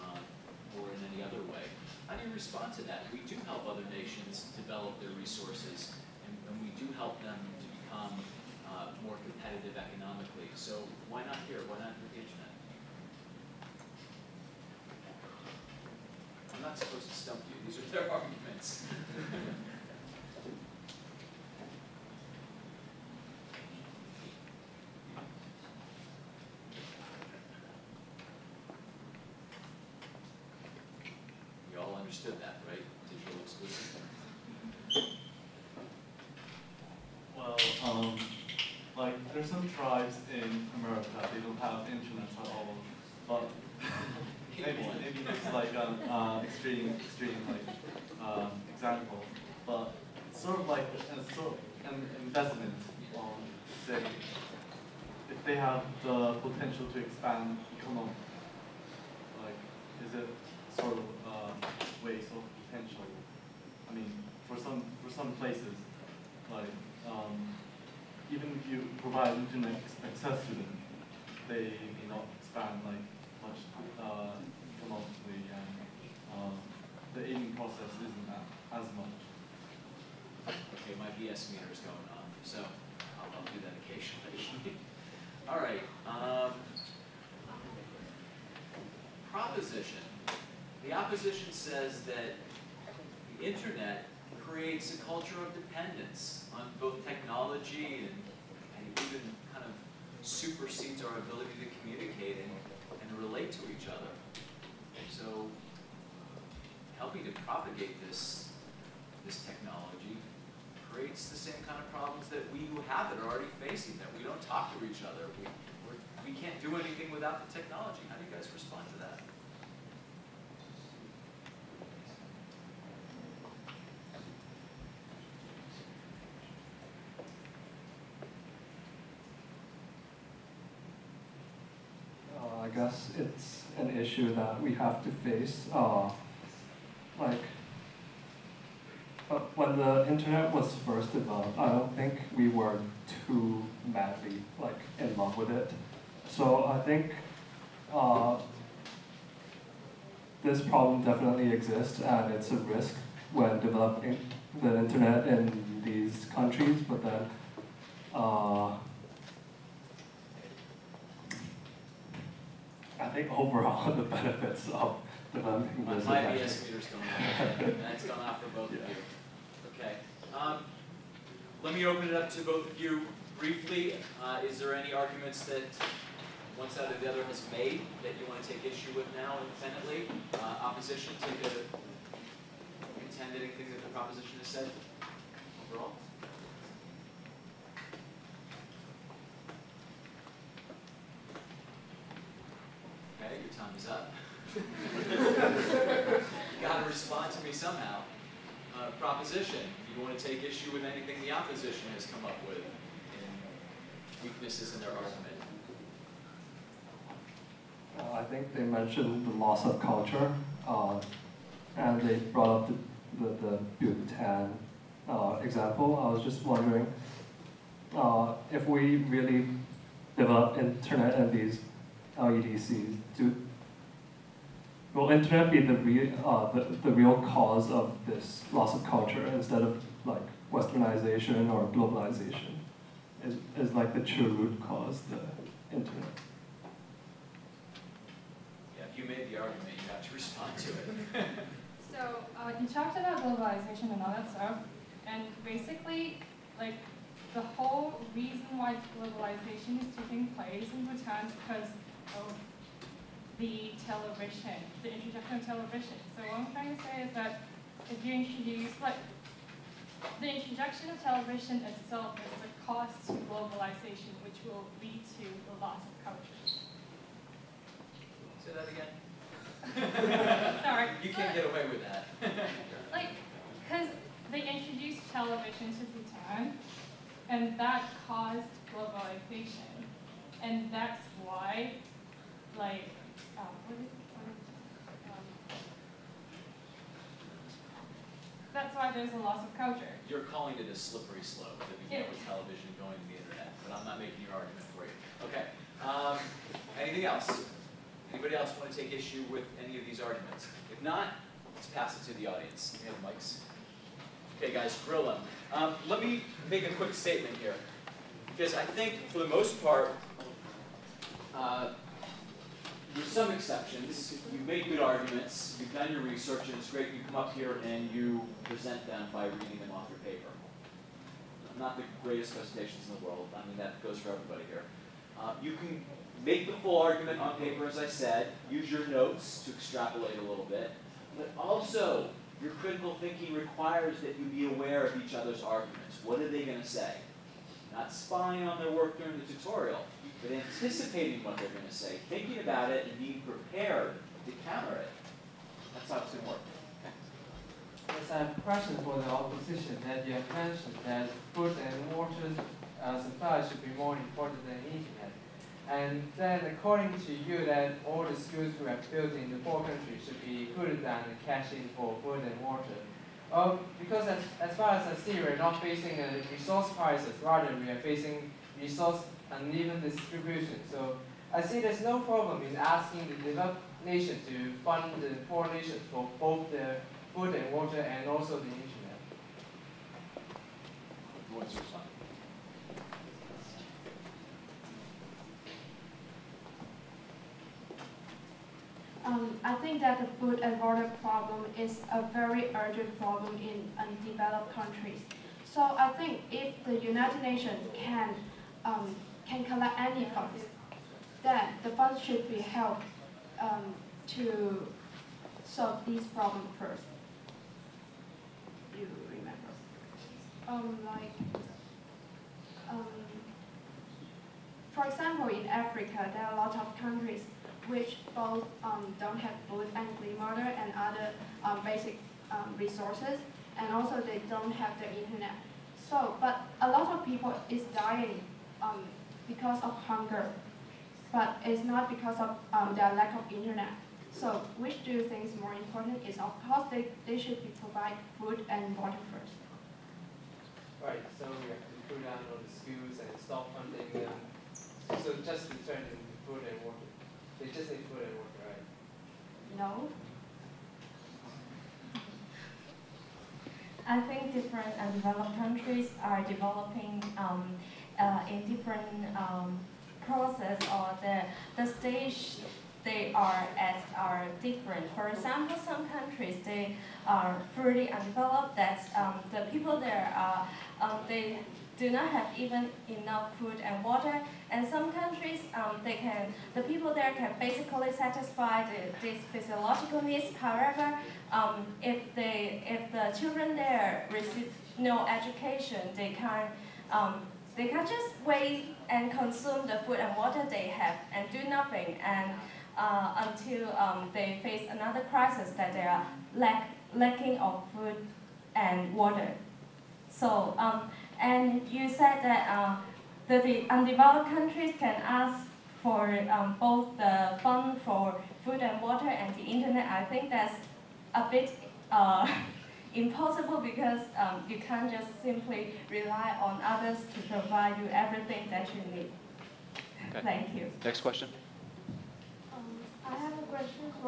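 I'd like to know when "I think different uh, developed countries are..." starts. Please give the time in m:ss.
7:33.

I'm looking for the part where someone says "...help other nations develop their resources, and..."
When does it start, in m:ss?
0:03.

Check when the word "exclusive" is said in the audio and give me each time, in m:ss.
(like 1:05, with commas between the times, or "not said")
0:33.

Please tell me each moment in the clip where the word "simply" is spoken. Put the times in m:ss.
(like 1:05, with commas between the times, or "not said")
8:35.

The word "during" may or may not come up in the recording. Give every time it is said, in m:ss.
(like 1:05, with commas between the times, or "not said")
5:38.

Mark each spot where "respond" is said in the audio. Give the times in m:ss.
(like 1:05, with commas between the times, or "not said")
0:02, 1:58, 3:16, 4:00.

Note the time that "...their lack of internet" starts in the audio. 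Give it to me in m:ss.
7:12.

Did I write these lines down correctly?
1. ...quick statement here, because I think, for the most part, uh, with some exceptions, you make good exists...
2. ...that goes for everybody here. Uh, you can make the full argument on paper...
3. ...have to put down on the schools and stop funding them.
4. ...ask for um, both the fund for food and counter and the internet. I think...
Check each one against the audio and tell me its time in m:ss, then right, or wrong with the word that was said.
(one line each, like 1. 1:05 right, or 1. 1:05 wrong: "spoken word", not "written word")
1. 5:06 wrong: "arguments", not "exists"
2. 5:23 right
3. 7:21 right
4. 8:25 wrong: "water", not "counter".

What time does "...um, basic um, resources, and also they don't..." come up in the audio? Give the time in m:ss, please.
7:01.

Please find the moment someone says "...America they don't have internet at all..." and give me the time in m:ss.
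0:40.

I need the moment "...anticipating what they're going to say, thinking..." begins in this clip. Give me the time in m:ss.
5:40.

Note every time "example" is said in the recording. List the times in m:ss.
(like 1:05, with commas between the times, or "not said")
0:48, 3:35, 6:54, 7:45.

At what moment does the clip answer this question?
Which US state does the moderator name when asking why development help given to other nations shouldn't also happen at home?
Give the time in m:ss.
0:12.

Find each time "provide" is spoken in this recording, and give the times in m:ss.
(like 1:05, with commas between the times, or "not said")
1:08, 7:17, 8:37.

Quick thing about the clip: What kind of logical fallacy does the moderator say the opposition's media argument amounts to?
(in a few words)
Slippery slope.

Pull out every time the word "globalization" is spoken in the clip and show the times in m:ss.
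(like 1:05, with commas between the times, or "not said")
3:51, 4:03, 4:08, 4:23, 4:38.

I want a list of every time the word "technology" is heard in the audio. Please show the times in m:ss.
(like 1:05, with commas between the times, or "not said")
1:37, 1:49, 1:57.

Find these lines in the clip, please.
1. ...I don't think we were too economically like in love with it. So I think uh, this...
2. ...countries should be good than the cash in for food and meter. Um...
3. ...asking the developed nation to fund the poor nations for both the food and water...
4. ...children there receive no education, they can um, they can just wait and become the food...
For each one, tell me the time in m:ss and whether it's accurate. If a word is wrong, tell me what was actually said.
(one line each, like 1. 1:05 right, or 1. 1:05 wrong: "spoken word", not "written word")
1. 2:21 wrong: "madly", not "economically"
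2. 5:59 wrong: "water", not "meter"
3. 6:12 right
4. 8:03 wrong: "consume", not "become".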